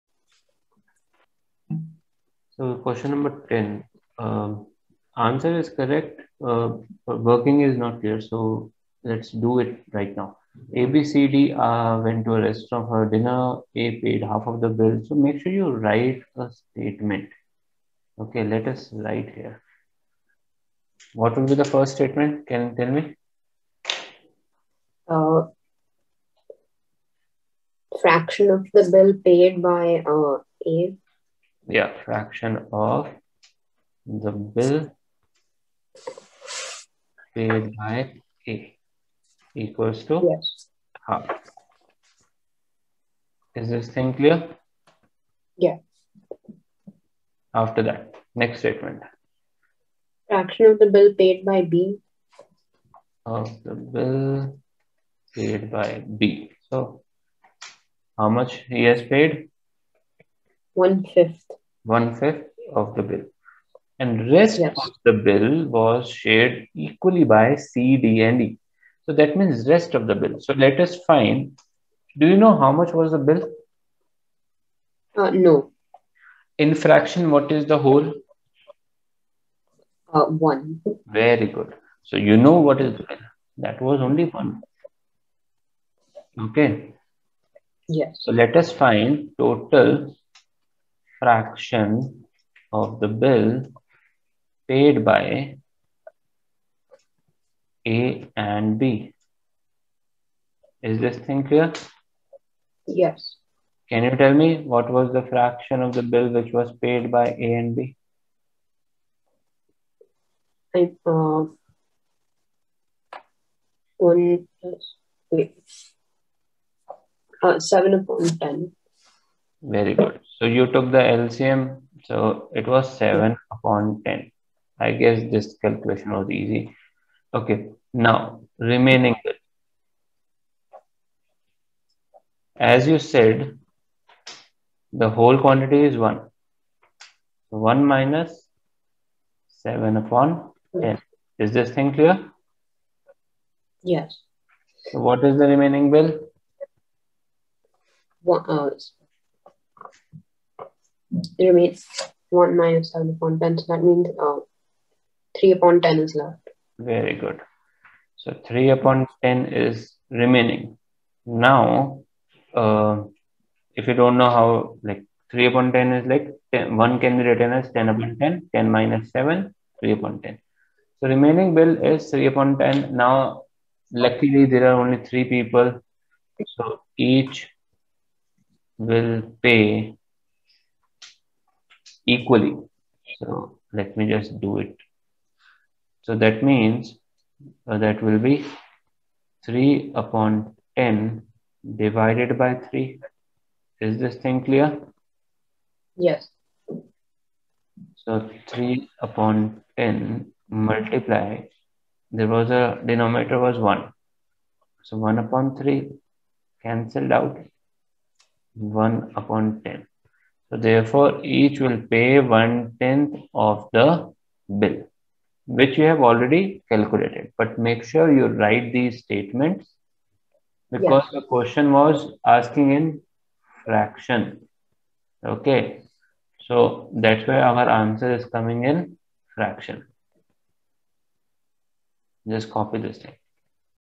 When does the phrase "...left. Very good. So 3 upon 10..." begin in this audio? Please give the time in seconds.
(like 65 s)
156 s.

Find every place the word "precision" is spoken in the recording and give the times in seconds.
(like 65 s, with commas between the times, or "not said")
not said.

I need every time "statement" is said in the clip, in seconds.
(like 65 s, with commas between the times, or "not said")
16 s, 21 s, 48 s, 219 s.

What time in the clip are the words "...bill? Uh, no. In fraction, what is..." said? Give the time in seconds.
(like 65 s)
73 s.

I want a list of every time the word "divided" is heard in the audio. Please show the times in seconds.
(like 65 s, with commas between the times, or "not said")
191 s.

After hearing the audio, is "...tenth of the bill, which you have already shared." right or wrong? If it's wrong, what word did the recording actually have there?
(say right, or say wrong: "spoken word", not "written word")
wrong: "calculated", not "shared".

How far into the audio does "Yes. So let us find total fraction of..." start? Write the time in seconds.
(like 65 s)
87 s.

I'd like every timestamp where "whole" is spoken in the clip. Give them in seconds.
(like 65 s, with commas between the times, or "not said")
77 s, 135 s.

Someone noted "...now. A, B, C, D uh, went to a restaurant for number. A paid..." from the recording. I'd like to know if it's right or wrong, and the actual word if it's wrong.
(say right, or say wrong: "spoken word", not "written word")
wrong: "dinner", not "number".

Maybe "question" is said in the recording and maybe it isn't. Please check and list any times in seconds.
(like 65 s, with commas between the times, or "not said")
2 s, 221 s.